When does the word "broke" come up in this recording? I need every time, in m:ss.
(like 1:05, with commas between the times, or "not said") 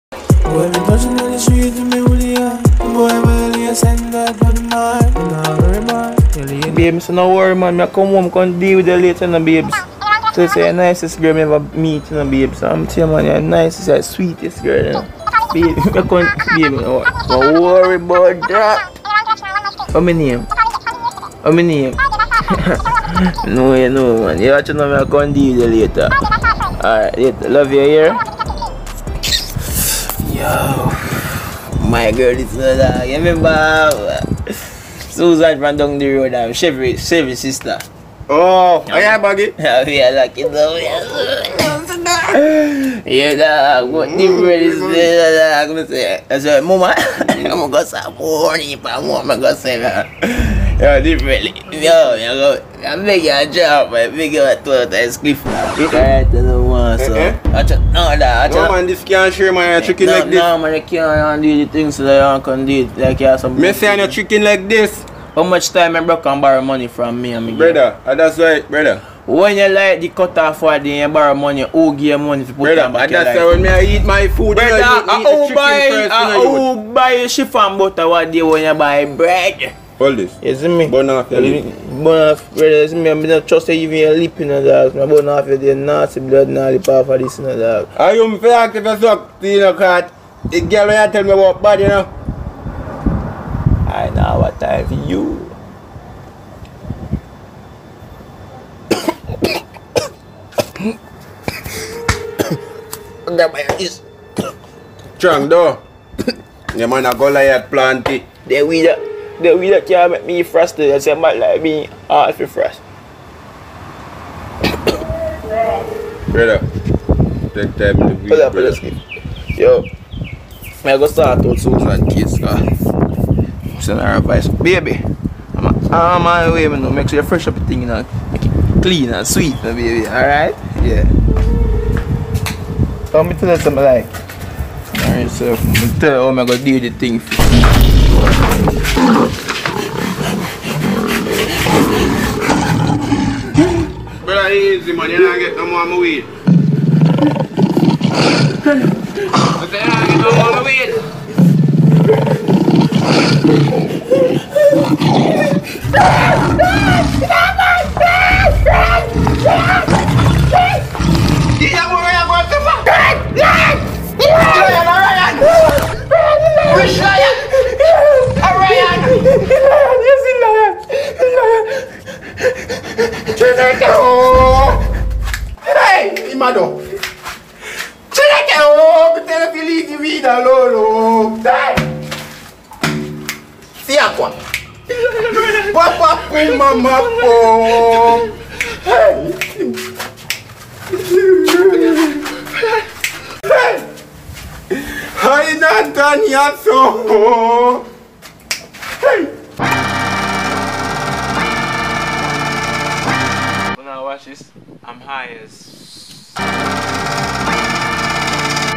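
1:06.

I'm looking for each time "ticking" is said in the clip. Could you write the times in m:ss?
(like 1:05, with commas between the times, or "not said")
not said.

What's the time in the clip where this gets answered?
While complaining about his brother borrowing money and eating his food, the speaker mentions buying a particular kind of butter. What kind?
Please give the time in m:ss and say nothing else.
1:17.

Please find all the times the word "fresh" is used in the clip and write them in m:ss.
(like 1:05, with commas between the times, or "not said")
1:52, 2:07.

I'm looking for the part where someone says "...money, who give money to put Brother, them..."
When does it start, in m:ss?
1:11.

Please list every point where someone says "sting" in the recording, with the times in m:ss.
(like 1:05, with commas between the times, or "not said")
not said.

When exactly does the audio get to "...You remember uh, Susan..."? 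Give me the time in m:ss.
0:33.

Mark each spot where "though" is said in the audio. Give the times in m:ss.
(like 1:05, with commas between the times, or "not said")
1:45.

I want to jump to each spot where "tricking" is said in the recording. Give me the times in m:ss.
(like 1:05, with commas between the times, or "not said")
0:59, 1:04.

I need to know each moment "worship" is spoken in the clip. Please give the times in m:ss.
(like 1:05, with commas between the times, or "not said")
not said.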